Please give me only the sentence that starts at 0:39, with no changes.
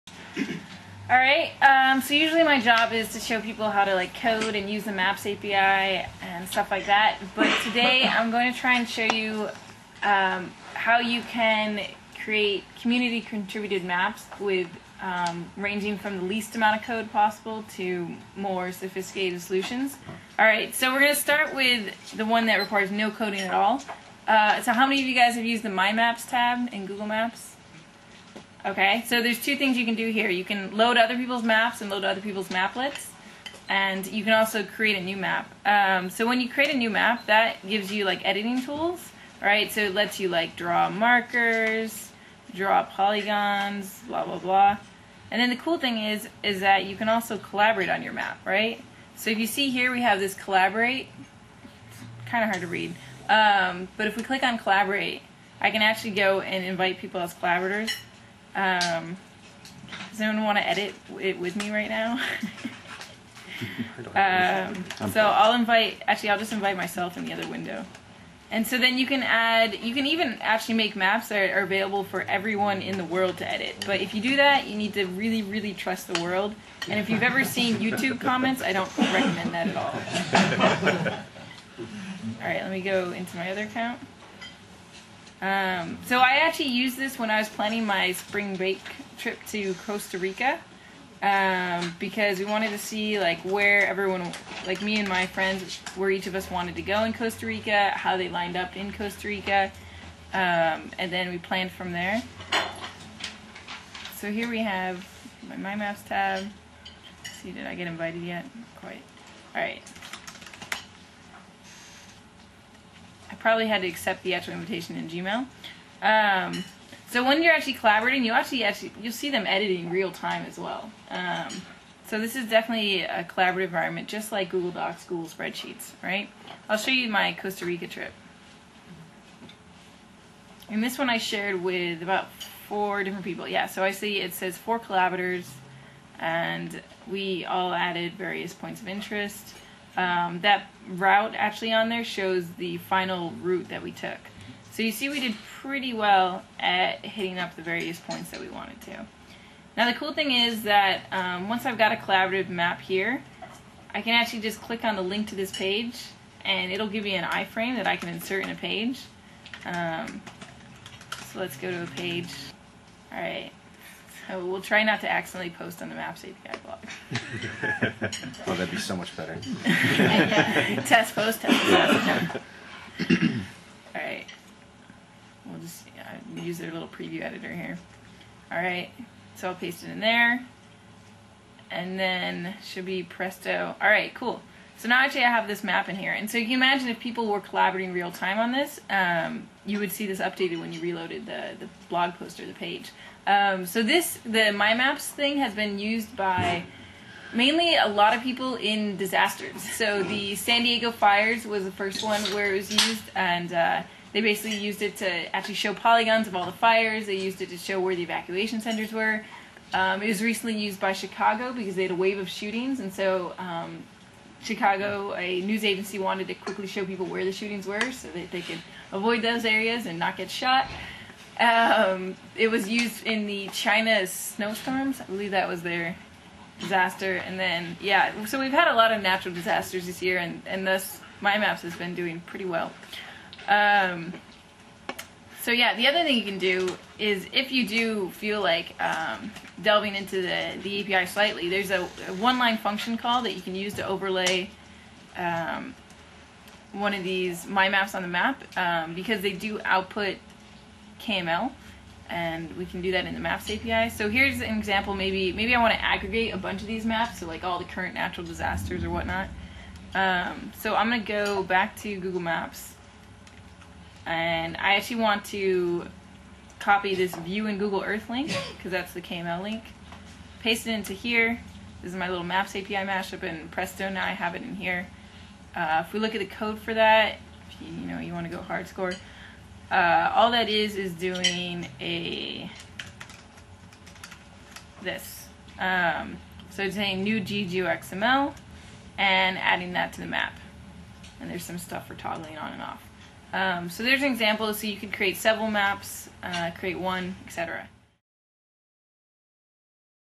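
So it lets you like draw markers, draw polygons, blah blah blah.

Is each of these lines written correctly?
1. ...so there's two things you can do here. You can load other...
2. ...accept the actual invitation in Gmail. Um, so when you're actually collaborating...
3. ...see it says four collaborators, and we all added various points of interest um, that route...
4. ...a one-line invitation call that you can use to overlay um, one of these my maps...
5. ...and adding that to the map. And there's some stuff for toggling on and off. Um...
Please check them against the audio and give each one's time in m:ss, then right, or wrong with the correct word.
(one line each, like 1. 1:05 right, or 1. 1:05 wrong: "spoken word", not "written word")
1. 0:29 right
2. 1:53 right
3. 2:13 right
4. 4:02 wrong: "function", not "invitation"
5. 4:48 right.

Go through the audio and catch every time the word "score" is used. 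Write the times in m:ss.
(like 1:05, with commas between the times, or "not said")
4:38.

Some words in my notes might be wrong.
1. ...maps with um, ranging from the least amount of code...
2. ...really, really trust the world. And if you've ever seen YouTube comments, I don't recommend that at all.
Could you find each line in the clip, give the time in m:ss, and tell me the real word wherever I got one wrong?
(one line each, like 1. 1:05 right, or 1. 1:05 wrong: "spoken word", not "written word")
1. 0:13 right
2. 1:15 right.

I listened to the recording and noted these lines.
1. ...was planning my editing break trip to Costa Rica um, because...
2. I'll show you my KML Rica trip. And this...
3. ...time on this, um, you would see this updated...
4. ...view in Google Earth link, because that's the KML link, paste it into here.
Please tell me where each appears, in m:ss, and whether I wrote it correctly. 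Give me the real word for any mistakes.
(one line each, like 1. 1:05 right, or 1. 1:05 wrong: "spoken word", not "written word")
1. 1:27 wrong: "spring", not "editing"
2. 2:06 wrong: "Costa", not "KML"
3. 3:08 right
4. 4:27 right.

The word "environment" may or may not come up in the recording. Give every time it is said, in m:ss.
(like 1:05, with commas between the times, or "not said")
2:03.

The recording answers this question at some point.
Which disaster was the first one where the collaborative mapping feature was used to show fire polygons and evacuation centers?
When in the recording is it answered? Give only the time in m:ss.
3:20.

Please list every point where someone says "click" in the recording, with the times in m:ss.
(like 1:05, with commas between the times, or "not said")
0:54, 2:34.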